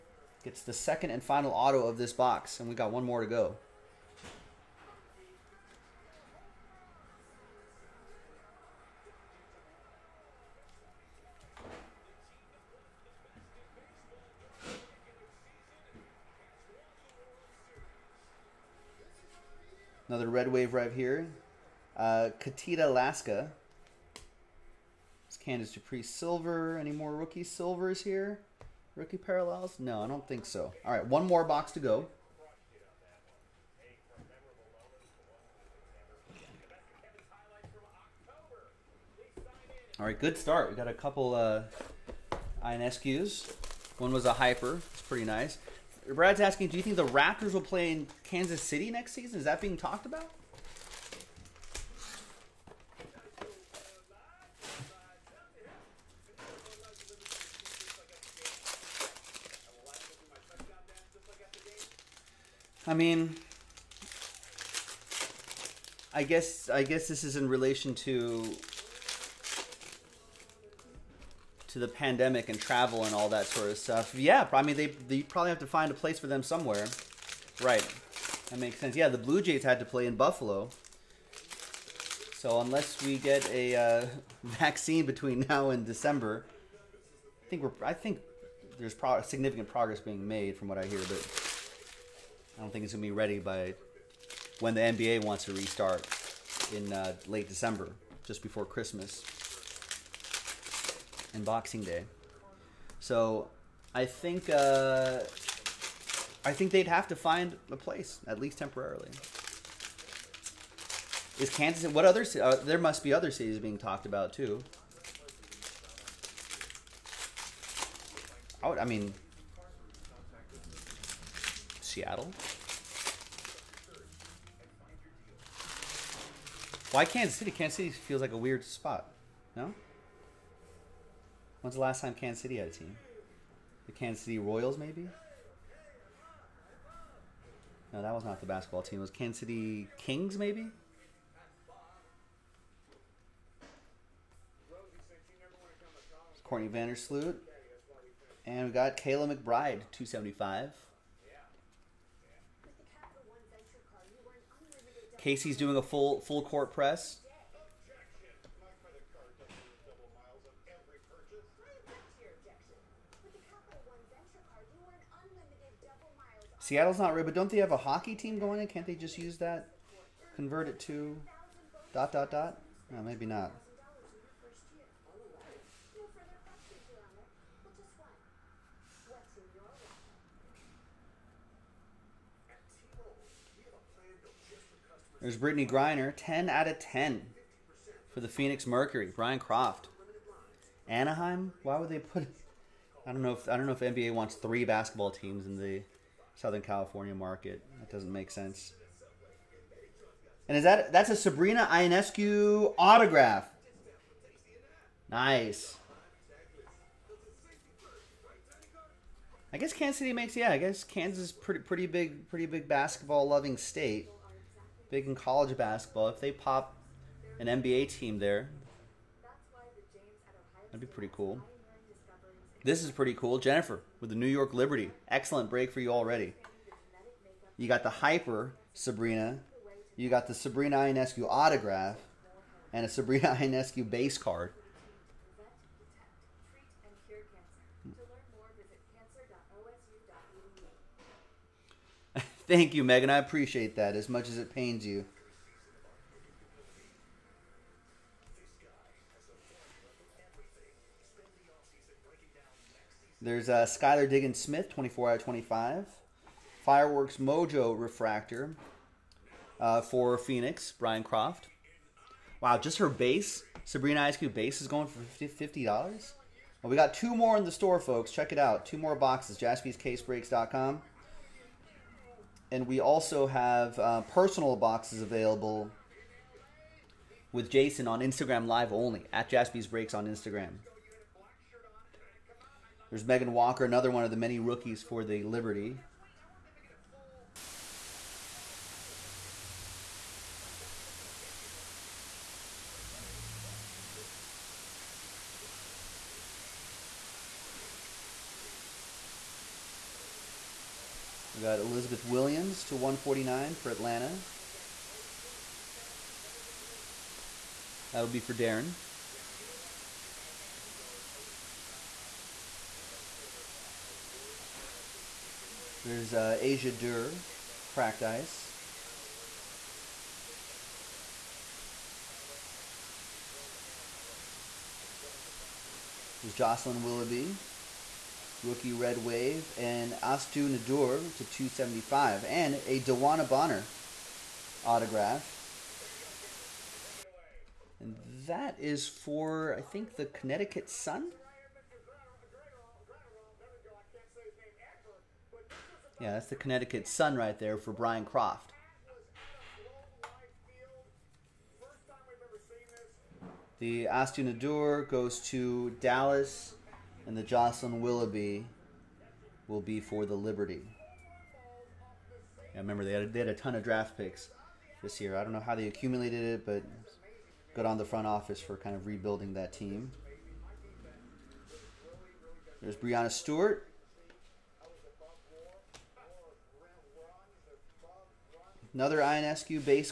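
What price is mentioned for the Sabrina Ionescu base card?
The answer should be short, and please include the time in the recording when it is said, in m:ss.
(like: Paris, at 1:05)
$50, at 4:25.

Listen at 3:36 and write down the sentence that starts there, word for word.
If they pop an NBA team there, that'd be pretty cool.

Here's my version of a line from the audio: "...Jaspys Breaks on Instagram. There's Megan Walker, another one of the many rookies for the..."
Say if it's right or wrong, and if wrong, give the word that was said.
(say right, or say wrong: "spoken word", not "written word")
right.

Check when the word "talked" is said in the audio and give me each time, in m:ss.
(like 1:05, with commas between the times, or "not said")
0:49, 1:53.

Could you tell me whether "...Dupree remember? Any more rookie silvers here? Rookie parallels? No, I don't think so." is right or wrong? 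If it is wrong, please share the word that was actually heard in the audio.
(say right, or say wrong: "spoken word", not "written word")
wrong: "silver", not "remember".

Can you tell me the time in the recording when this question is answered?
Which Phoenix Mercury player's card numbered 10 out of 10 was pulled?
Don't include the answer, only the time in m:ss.
3:05.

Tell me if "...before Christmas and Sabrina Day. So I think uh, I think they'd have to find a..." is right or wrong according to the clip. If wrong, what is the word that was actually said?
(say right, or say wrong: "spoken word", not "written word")
wrong: "Boxing", not "Sabrina".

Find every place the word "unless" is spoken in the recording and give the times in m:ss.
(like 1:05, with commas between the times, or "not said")
1:22.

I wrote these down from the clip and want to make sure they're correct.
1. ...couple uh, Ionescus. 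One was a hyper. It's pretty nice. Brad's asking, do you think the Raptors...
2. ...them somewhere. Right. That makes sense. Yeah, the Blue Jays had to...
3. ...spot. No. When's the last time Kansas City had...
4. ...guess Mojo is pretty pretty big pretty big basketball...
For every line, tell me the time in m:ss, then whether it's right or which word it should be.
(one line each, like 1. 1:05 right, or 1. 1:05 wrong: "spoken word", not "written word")
1. 0:40 right
2. 1:16 right
3. 2:08 right
4. 3:30 wrong: "Kansas", not "Mojo".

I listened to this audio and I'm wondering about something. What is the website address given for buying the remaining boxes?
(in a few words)
jaspyscasebreaks.com.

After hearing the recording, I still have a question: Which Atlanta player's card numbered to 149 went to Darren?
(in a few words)
Elizabeth Williams.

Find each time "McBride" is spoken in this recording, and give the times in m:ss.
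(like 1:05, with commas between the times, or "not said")
2:29.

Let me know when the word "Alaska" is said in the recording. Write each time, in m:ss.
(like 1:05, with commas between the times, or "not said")
0:22.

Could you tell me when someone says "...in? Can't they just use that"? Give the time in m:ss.
2:48.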